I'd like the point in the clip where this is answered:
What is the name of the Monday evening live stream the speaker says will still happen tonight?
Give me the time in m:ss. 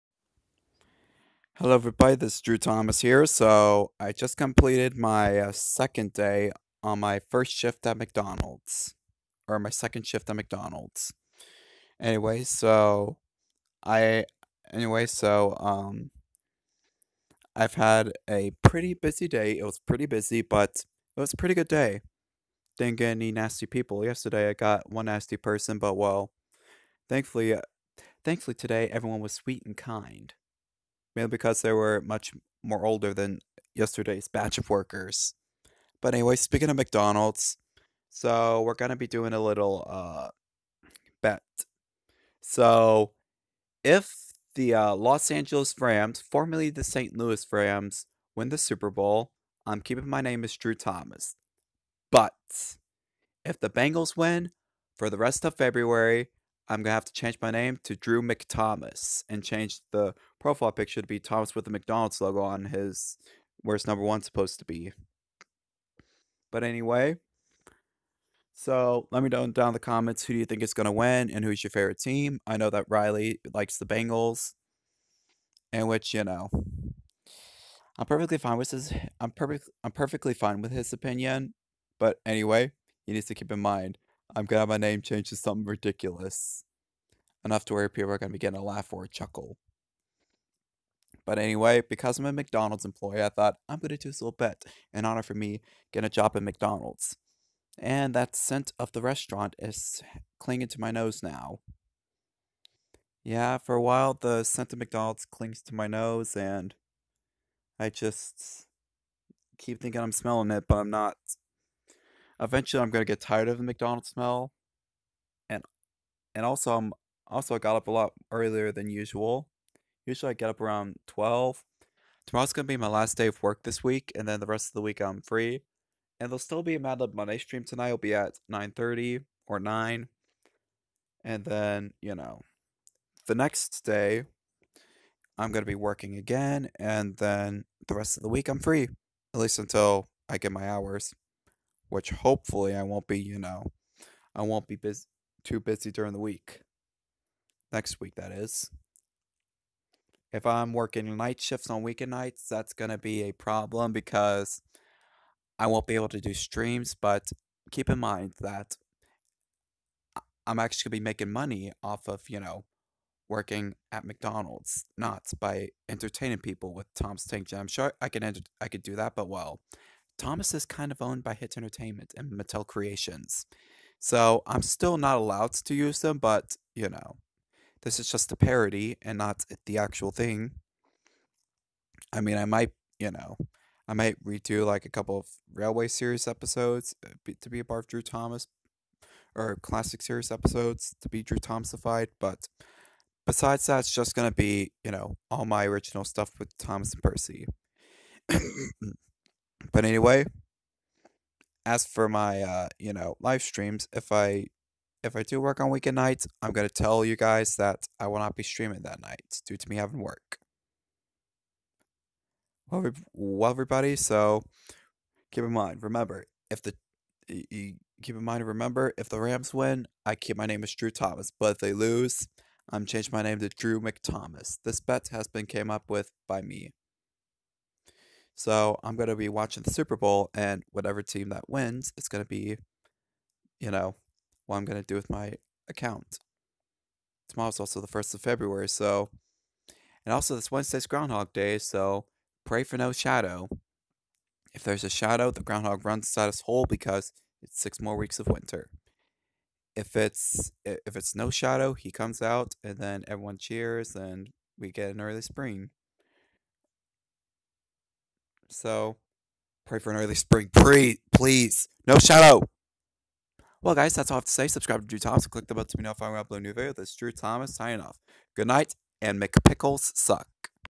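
2:06.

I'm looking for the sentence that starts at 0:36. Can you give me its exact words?
But anyway, speaking of McDonald's, so we're gonna be doing a little uh bet.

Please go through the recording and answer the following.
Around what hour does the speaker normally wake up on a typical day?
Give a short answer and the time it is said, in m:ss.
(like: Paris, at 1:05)
12, at 2:01.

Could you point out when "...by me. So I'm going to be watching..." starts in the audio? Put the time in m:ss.
3:46.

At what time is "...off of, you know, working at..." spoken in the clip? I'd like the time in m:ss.
2:41.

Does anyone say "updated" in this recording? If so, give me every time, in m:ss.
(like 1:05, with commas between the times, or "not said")
not said.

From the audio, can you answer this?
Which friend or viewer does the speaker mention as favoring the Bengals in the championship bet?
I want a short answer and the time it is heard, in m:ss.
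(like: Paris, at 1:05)
Riley, at 1:12.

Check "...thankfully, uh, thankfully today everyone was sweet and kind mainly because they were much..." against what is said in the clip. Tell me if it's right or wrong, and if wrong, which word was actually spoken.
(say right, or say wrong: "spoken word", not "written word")
right.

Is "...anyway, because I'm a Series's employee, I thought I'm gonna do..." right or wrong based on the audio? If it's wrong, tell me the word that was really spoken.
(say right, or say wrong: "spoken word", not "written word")
wrong: "McDonald", not "Series".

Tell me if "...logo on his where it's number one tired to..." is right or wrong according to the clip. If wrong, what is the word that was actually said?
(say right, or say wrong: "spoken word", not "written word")
wrong: "supposed", not "tired".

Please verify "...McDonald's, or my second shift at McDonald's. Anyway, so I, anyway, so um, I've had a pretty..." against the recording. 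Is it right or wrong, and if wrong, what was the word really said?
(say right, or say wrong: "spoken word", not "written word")
right.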